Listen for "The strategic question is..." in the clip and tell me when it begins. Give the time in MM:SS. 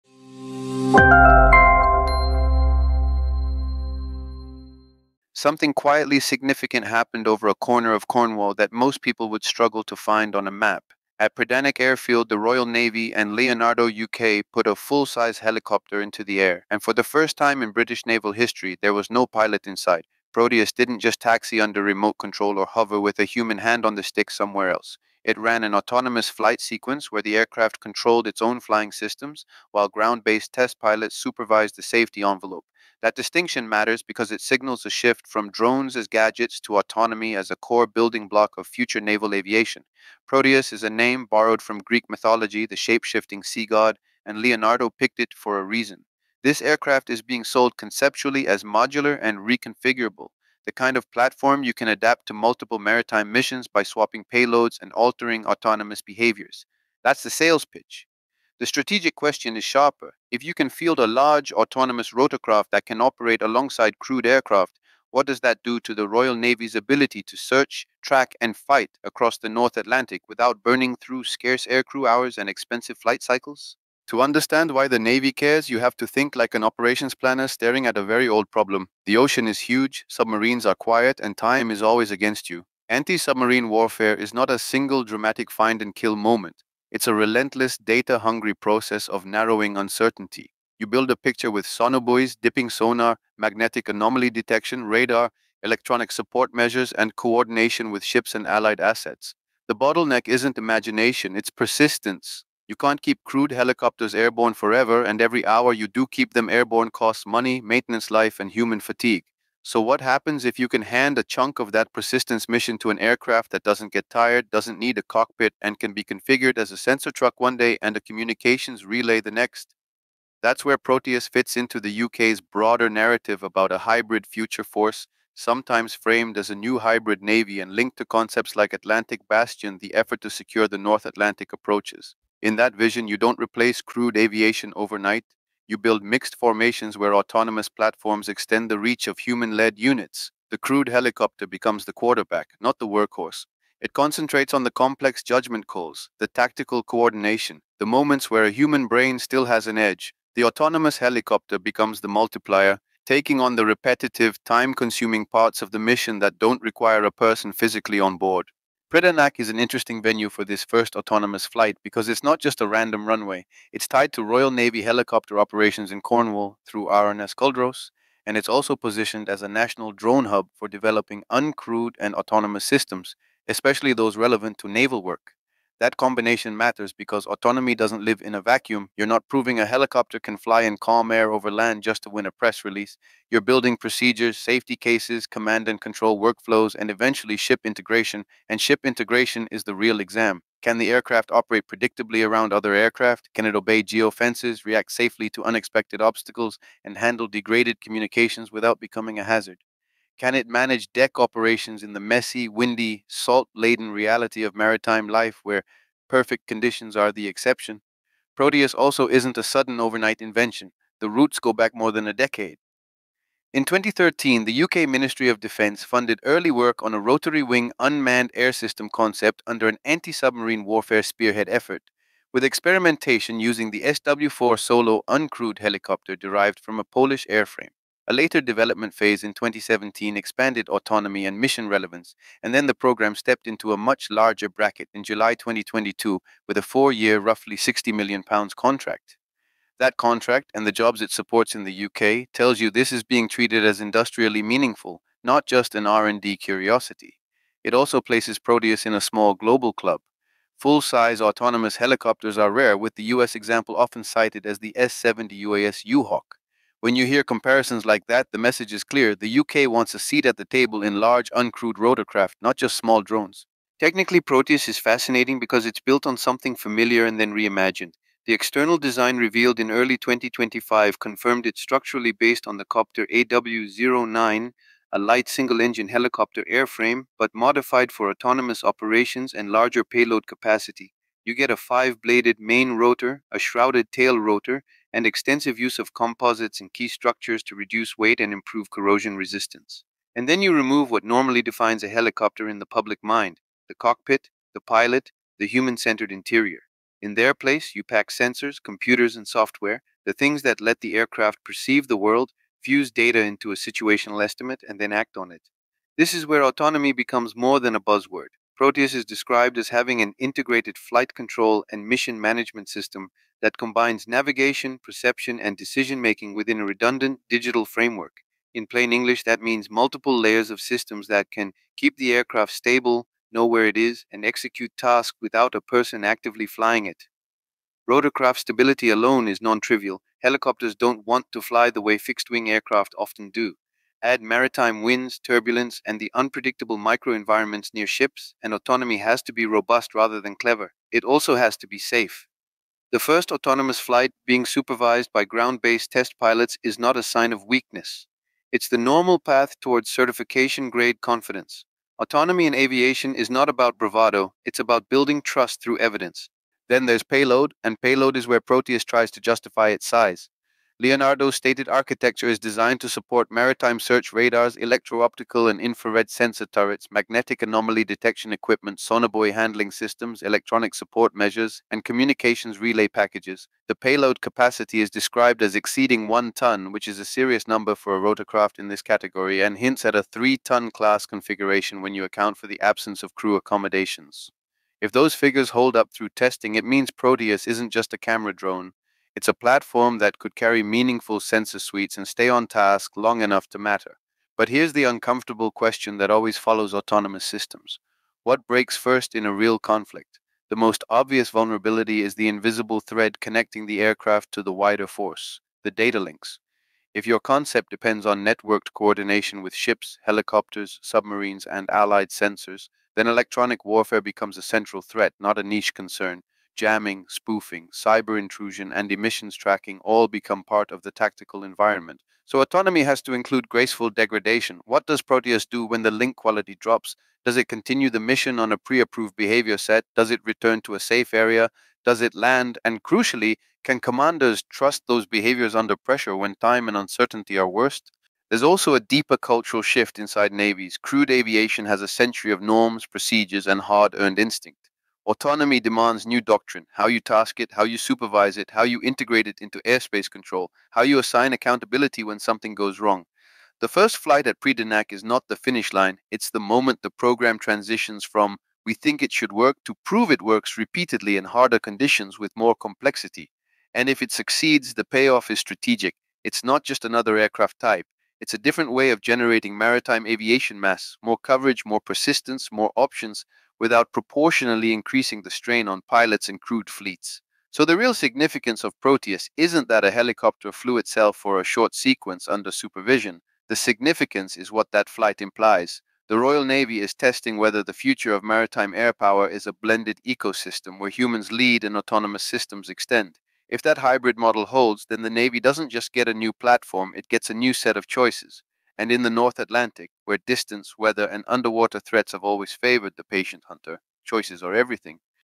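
00:58.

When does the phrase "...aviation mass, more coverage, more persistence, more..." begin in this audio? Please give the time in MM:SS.
07:50.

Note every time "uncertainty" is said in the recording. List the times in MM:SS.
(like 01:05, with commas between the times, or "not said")
01:29, 07:16.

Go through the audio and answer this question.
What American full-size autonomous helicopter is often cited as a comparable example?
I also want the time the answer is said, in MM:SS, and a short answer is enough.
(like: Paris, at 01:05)
S-70 UAS U-Hawk, at 04:14.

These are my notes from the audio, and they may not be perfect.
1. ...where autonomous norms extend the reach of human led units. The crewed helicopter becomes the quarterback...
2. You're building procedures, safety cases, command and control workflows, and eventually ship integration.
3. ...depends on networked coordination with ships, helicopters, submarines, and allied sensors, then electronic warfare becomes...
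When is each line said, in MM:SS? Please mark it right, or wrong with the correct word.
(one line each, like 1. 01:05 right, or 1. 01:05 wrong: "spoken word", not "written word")
1. 02:16 wrong: "platforms", not "norms"
2. 03:03 right
3. 06:47 right.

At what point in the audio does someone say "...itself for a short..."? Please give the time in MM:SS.
08:00.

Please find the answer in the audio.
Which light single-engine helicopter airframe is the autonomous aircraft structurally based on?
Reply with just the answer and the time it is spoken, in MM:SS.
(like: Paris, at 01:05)
Kopter AW09, at 04:32.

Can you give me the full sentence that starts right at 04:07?
It also places Proteus in a small global club.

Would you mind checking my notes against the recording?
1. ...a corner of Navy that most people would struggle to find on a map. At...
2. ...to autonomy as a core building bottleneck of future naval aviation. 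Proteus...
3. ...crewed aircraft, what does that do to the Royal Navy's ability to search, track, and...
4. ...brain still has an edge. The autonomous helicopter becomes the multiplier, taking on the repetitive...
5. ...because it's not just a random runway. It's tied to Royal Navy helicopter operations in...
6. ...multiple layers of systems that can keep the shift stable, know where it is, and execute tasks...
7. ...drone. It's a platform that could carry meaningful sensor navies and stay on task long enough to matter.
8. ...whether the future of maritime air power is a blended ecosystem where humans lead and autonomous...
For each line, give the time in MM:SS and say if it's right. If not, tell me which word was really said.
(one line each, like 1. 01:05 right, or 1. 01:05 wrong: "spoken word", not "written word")
1. 00:07 wrong: "Cornwall", not "Navy"
2. 00:36 wrong: "block", not "bottleneck"
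3. 01:03 right
4. 02:28 right
5. 02:41 right
6. 05:19 wrong: "aircraft", not "shift"
7. 06:28 wrong: "suites", not "navies"
8. 08:07 right.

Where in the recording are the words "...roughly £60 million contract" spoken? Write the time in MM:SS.
03:57.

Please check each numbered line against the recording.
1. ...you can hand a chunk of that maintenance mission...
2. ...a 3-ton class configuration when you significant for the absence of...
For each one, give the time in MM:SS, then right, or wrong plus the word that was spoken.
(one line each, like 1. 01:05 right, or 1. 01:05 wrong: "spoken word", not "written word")
1. 01:50 wrong: "persistence", not "maintenance"
2. 06:19 wrong: "account", not "significant".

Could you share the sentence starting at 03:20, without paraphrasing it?
Can it manage deck operations in the messy, windy, salt laden reality of maritime life where perfect conditions are the exception?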